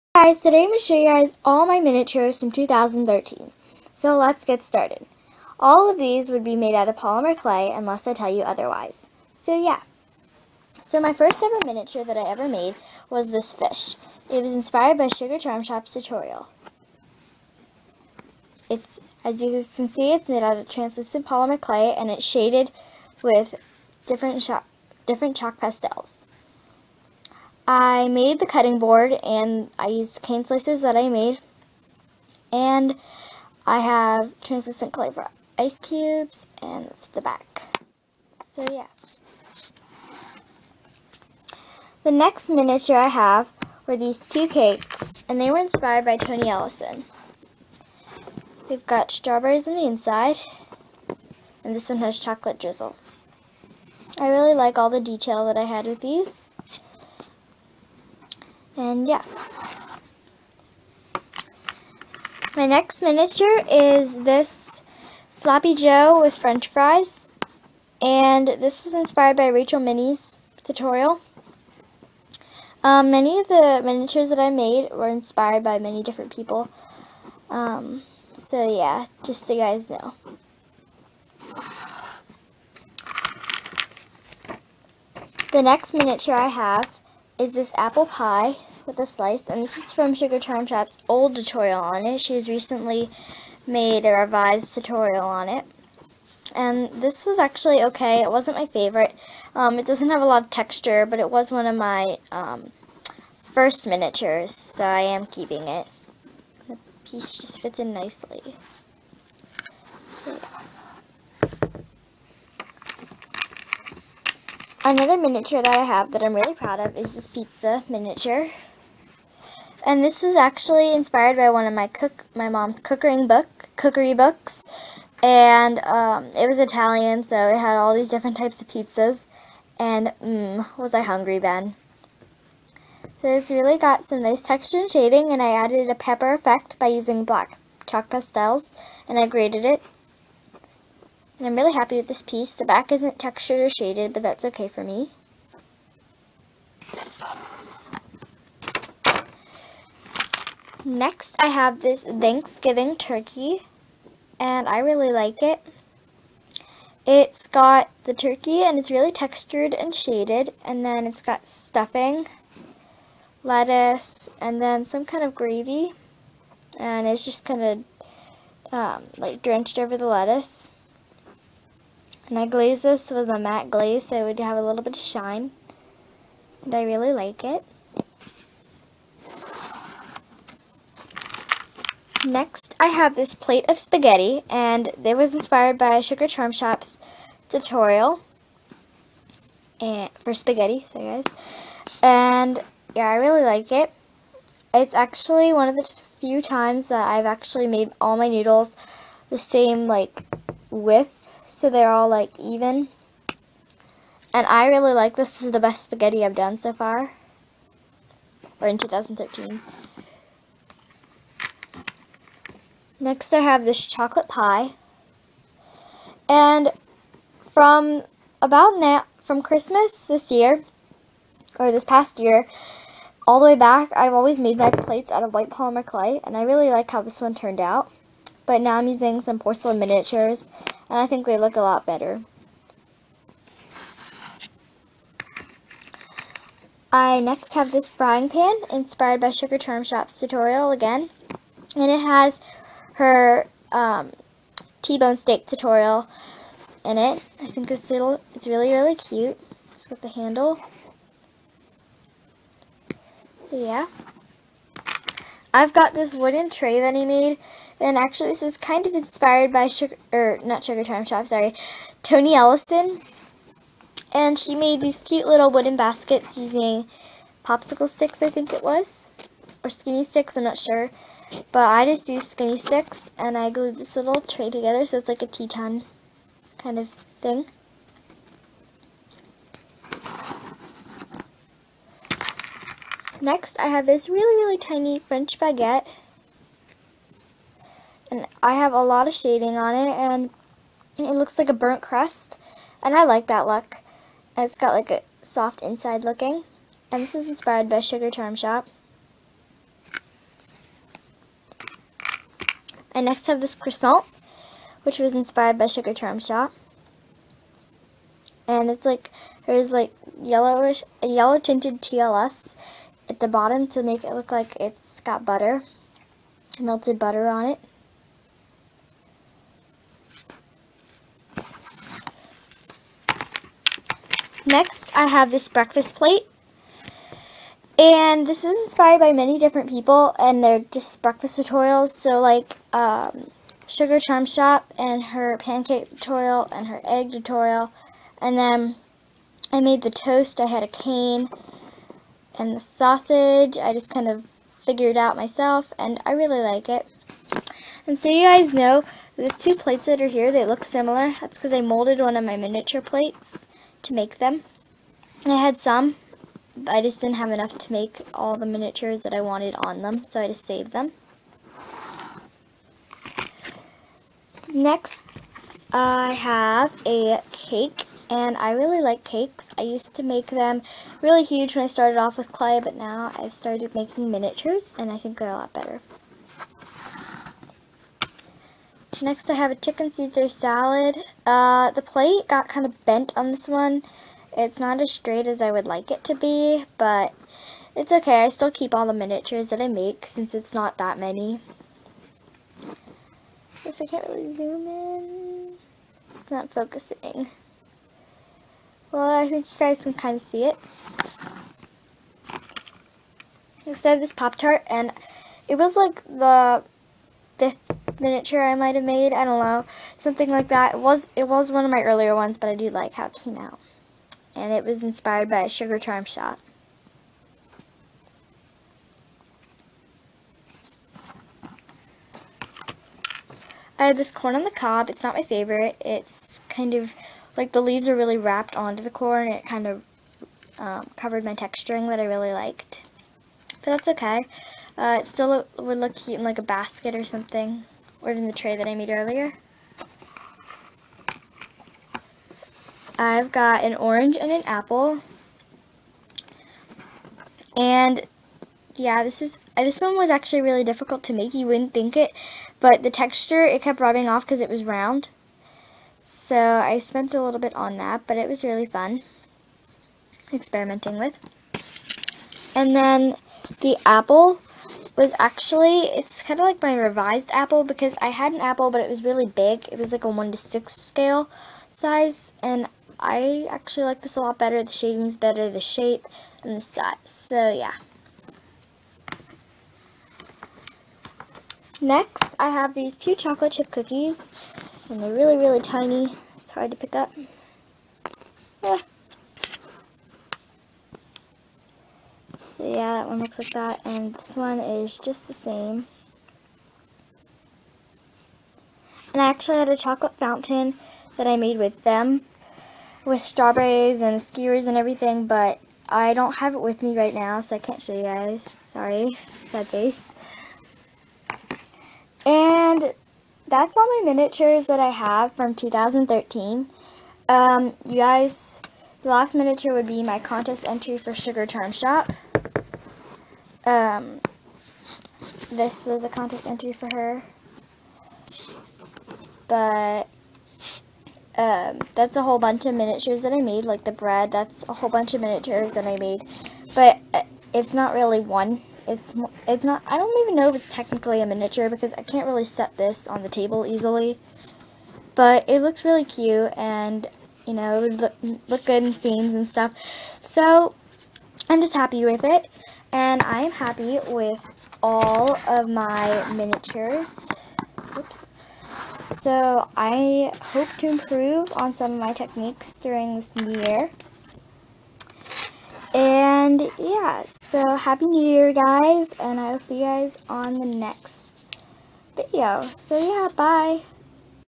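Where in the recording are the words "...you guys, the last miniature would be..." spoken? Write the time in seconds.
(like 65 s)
517 s.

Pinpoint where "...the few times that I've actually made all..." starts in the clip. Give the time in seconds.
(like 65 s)
195 s.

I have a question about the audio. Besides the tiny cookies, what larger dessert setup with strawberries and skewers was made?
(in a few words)
chocolate fountain.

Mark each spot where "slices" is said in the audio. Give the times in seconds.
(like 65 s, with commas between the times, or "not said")
30 s, 89 s.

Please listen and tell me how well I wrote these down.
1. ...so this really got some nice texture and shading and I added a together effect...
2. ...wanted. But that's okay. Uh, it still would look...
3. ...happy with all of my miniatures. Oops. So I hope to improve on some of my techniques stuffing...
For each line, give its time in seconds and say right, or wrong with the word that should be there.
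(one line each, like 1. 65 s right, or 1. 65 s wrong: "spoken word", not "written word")
1. 133 s wrong: "pepper", not "together"
2. 432 s wrong: "liked", not "wanted"
3. 553 s wrong: "during", not "stuffing".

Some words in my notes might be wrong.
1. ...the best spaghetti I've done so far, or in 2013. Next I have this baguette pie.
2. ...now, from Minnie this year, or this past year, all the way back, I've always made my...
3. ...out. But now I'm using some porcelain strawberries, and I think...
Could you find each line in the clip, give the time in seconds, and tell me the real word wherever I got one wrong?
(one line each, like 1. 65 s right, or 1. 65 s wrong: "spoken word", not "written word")
1. 205 s wrong: "chocolate", not "baguette"
2. 218 s wrong: "Christmas", not "Minnie"
3. 227 s wrong: "miniatures", not "strawberries".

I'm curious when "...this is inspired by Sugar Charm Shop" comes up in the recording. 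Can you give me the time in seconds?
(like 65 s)
297 s.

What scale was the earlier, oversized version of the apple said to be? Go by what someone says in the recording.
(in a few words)
1 to 6.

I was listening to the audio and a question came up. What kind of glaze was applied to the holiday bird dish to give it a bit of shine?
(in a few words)
matte glaze.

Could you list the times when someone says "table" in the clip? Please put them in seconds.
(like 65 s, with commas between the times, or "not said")
543 s.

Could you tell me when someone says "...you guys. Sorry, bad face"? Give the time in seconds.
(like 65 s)
507 s.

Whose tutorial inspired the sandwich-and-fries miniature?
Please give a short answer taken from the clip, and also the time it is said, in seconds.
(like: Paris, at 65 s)
Rachel Minnie, at 69 s.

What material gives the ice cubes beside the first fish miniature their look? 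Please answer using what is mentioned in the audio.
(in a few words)
translucent clay.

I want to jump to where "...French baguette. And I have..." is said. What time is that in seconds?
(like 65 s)
284 s.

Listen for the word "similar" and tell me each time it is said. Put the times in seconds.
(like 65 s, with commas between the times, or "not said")
350 s.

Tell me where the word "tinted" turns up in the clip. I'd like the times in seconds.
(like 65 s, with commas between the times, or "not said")
311 s.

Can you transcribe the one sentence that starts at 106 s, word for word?
The piece just fits in nicely.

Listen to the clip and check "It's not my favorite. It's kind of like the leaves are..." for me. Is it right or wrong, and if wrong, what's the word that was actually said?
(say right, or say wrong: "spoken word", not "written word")
right.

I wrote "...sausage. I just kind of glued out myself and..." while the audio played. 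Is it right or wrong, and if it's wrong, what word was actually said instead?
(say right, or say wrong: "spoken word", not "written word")
wrong: "figured", not "glued".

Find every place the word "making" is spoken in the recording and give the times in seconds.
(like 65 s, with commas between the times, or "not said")
373 s.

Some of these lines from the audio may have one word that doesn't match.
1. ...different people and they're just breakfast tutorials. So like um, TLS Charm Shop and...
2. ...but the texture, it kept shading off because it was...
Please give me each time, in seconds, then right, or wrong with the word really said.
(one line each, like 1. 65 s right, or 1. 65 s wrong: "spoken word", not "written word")
1. 329 s wrong: "Sugar", not "TLS"
2. 452 s wrong: "rubbing", not "shading".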